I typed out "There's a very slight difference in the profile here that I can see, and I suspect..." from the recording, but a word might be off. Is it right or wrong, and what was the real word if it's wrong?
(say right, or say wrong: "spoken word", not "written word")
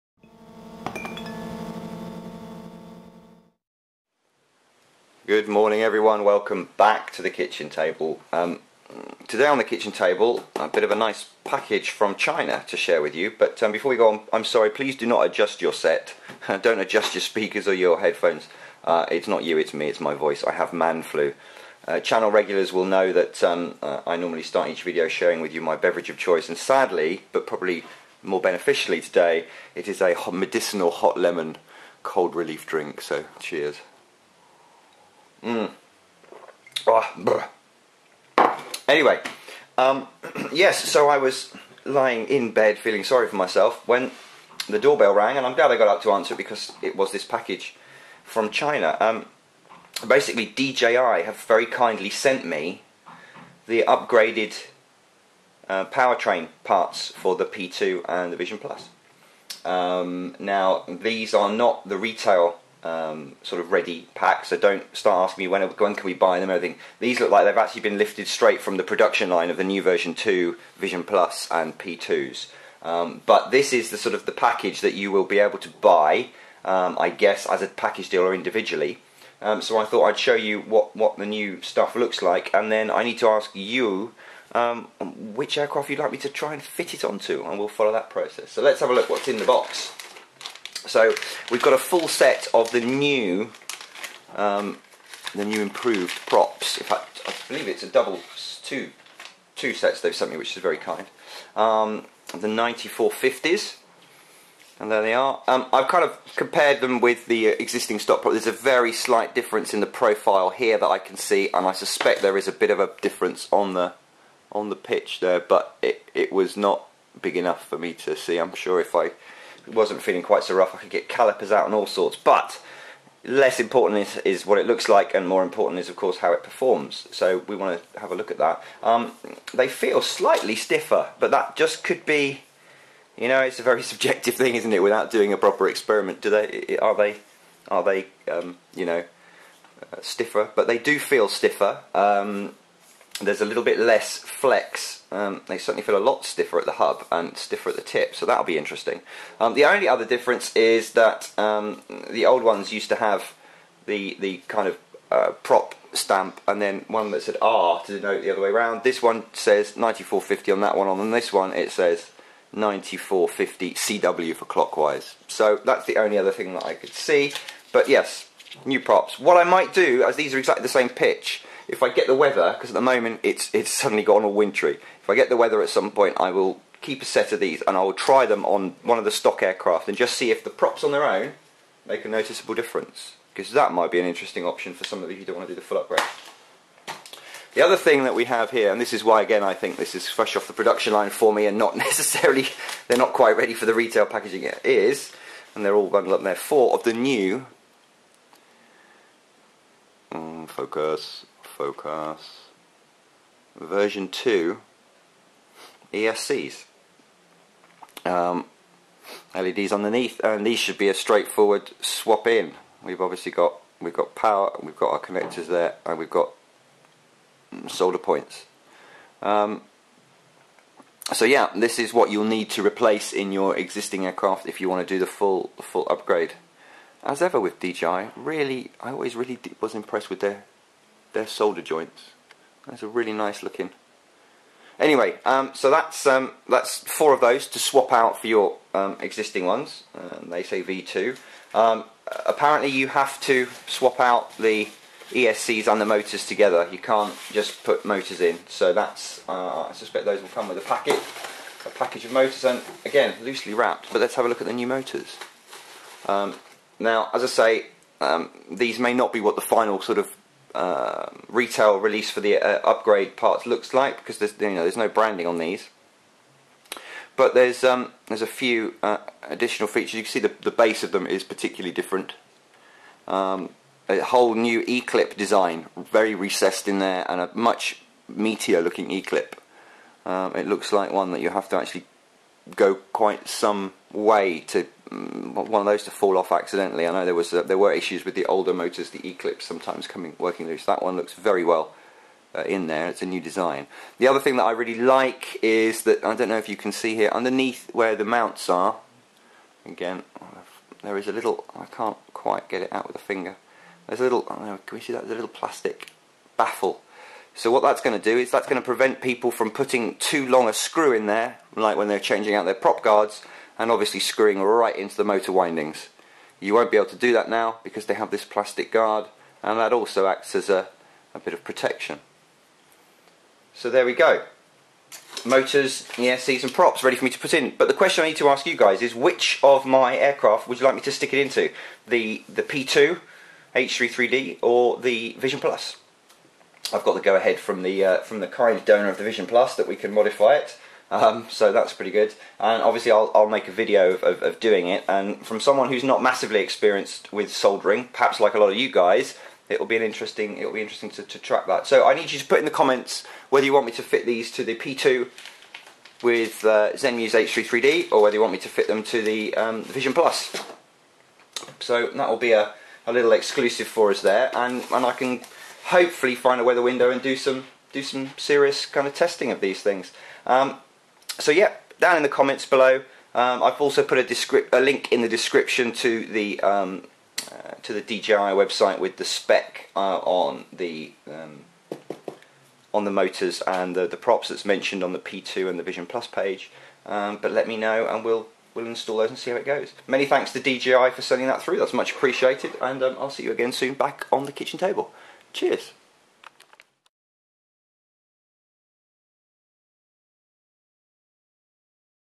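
right.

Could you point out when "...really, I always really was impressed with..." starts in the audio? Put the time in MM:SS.
03:48.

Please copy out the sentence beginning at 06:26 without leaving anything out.
Um, but let me know, and we'll we'll install those and see how it goes.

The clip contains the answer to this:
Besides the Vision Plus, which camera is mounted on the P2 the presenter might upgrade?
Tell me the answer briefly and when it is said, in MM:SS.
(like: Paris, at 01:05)
Zenmuse H3D, at 05:56.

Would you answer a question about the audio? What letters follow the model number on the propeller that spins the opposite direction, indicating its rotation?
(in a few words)
CW.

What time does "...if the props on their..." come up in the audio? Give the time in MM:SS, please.
03:00.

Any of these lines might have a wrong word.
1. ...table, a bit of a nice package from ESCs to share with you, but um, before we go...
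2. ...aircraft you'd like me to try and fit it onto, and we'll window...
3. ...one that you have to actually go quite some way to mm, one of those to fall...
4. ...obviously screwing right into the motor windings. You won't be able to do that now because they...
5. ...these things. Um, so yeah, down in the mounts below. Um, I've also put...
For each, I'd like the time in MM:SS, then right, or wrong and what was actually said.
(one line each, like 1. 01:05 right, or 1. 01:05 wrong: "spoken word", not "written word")
1. 00:09 wrong: "China", not "ESCs"
2. 01:25 wrong: "follow", not "window"
3. 04:40 right
4. 05:13 right
5. 06:09 wrong: "comments", not "mounts".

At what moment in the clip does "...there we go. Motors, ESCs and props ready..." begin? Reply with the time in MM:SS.
05:23.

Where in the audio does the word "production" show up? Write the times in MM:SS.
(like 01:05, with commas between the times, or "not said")
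01:08, 03:10.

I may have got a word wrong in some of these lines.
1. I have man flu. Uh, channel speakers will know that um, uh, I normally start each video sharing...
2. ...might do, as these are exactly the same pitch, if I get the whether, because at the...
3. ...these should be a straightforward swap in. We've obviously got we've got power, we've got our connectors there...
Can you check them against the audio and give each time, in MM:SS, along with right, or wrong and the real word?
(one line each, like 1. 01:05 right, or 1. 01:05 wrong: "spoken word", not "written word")
1. 00:20 wrong: "regulars", not "speakers"
2. 02:49 wrong: "weather", not "whether"
3. 03:30 right.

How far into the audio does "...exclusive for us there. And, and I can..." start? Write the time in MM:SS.
06:03.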